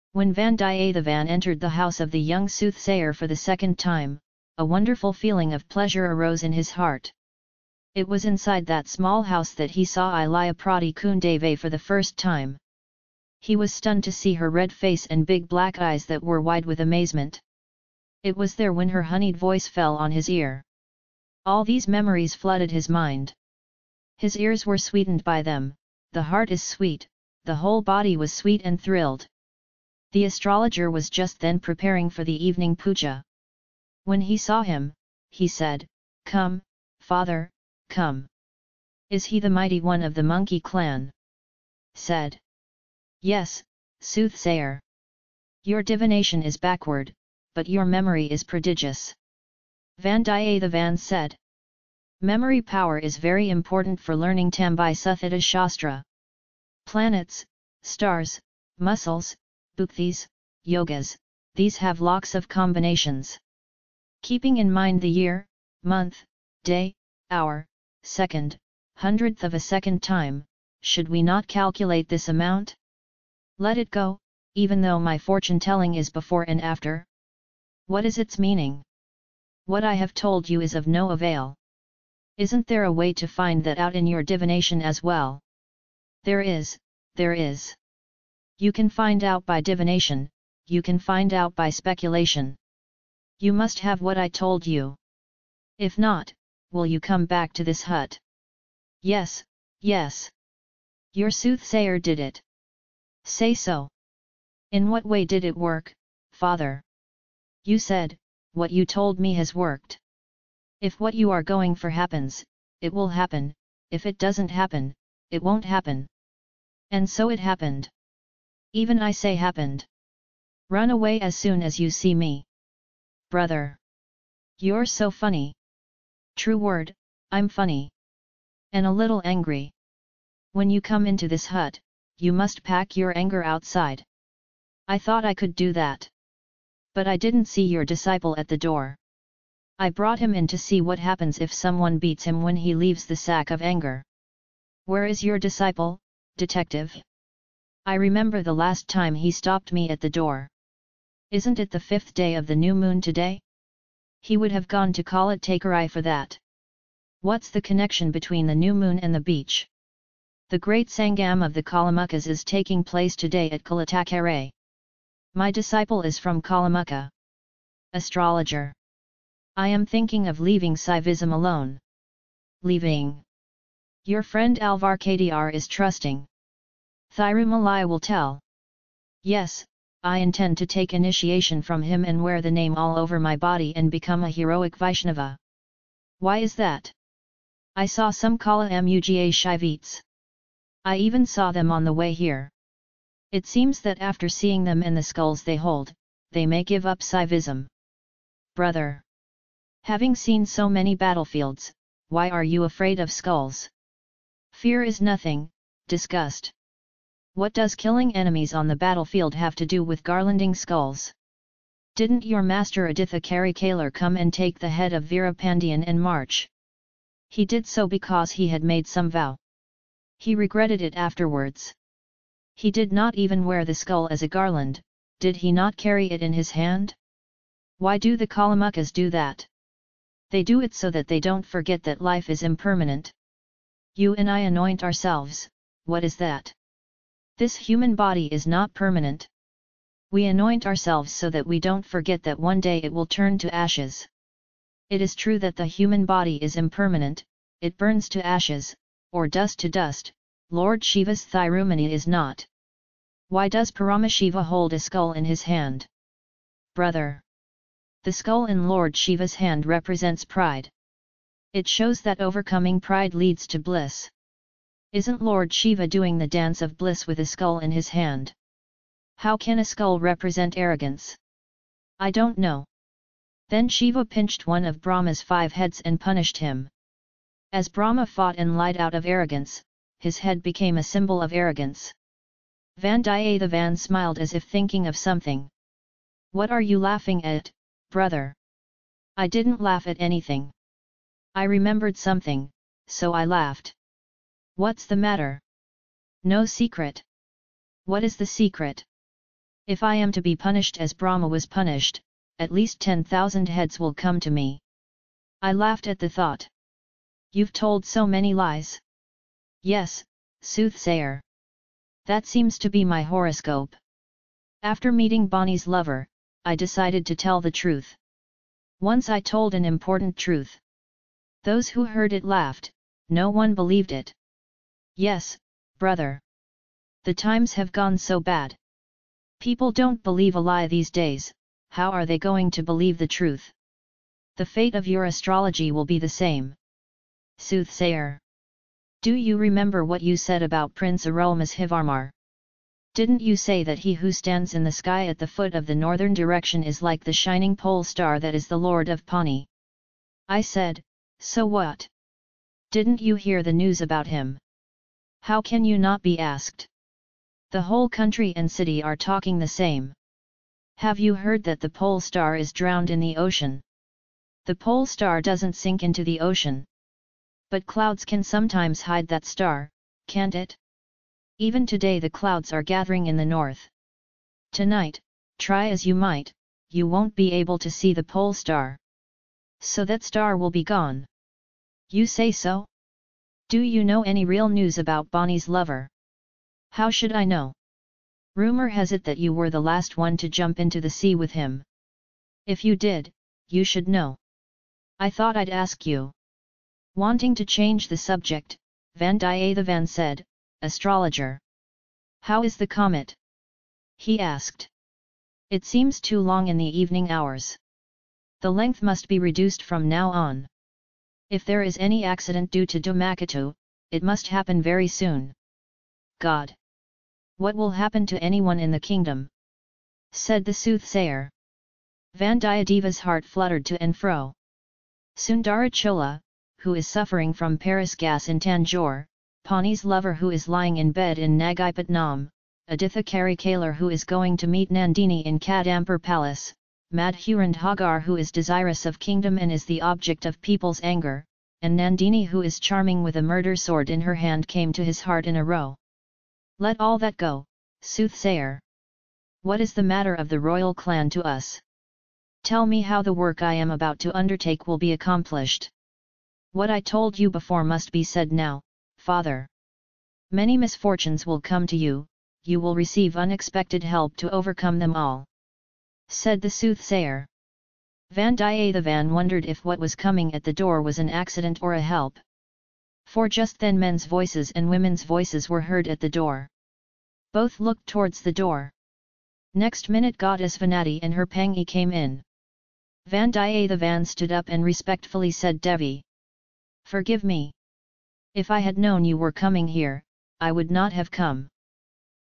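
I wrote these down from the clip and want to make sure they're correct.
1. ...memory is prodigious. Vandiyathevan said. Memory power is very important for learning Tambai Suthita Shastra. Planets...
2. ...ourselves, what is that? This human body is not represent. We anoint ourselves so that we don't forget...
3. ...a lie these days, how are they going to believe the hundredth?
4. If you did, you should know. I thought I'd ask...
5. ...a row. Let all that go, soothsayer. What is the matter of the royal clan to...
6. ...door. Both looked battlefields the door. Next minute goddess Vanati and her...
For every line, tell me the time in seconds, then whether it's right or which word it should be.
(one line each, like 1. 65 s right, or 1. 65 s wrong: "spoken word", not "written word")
1. 47 s right
2. 234 s wrong: "permanent", not "represent"
3. 330 s wrong: "truth", not "hundredth"
4. 392 s right
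5. 445 s right
6. 476 s wrong: "towards", not "battlefields".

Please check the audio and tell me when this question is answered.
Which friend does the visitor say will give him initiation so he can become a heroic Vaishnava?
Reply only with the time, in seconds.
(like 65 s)
174 s.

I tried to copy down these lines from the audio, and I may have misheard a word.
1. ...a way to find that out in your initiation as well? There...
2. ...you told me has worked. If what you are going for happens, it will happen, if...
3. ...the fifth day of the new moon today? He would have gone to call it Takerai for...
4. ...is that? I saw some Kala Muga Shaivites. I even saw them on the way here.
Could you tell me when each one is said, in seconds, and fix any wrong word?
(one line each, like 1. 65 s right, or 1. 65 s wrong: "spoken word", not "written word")
1. 82 s wrong: "divination", not "initiation"
2. 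108 s right
3. 151 s right
4. 186 s right.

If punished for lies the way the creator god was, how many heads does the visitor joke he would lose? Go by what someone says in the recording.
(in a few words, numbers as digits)
10,000.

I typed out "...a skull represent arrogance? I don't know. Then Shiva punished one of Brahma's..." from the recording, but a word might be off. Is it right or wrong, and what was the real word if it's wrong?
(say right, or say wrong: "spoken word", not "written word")
wrong: "pinched", not "punished".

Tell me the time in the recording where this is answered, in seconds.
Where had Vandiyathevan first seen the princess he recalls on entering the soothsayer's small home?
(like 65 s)
10 s.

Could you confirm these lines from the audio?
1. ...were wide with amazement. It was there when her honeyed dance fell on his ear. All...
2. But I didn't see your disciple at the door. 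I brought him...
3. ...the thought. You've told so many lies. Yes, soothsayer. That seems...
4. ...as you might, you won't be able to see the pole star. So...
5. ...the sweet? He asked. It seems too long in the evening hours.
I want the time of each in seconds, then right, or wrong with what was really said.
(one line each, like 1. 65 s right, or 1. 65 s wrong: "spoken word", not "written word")
1. 16 s wrong: "voice", not "dance"
2. 136 s right
3. 305 s right
4. 375 s right
5. 402 s wrong: "comet", not "sweet".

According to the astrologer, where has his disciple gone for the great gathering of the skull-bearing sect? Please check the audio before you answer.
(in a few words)
Kalatakere.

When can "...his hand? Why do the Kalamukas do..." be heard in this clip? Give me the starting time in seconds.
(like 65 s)
226 s.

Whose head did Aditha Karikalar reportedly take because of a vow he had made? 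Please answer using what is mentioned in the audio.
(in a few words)
Pandian.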